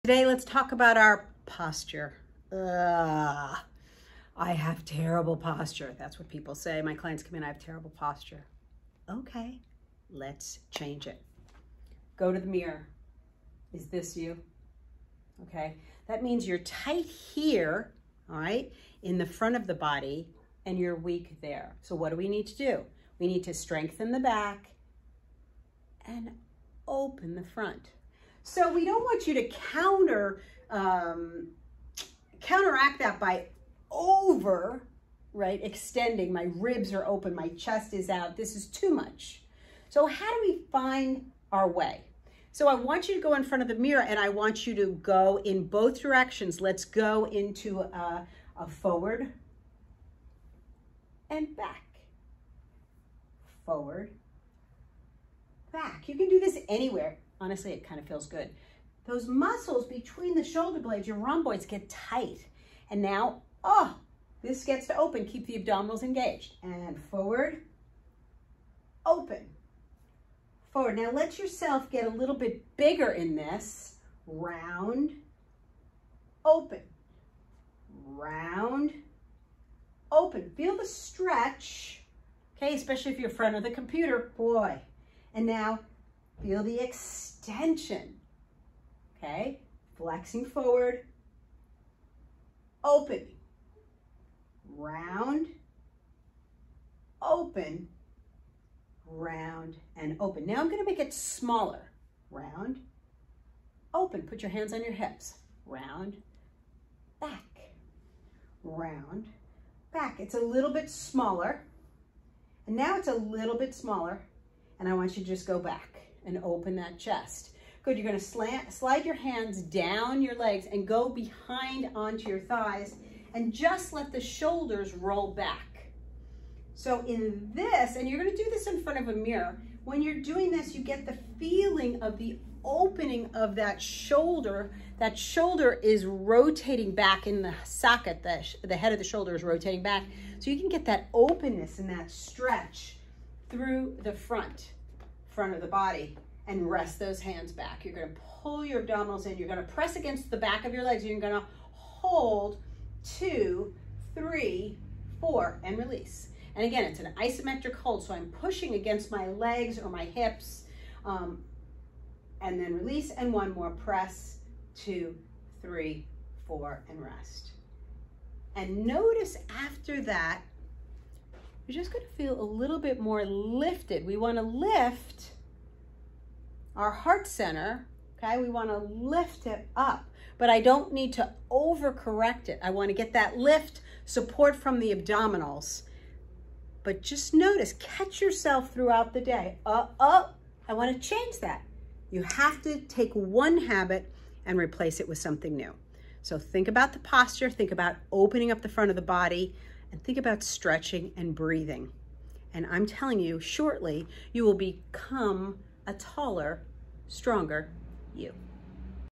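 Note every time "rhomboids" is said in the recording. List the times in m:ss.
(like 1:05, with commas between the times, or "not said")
1:01.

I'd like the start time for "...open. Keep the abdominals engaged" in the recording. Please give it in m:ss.
1:04.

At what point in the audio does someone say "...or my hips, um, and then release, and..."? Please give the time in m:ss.
2:39.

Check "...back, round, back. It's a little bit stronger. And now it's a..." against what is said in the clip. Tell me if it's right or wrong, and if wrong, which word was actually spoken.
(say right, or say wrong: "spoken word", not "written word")
wrong: "smaller", not "stronger".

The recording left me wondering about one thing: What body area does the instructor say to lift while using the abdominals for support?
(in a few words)
Heart center.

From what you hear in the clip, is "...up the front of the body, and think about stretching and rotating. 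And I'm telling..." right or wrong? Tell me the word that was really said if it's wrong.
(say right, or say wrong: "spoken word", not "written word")
wrong: "breathing", not "rotating".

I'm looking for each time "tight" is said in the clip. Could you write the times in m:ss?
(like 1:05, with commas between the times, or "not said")
0:16, 1:01.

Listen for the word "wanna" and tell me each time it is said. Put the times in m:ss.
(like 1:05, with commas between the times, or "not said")
2:54, 2:58, 3:02, 3:10.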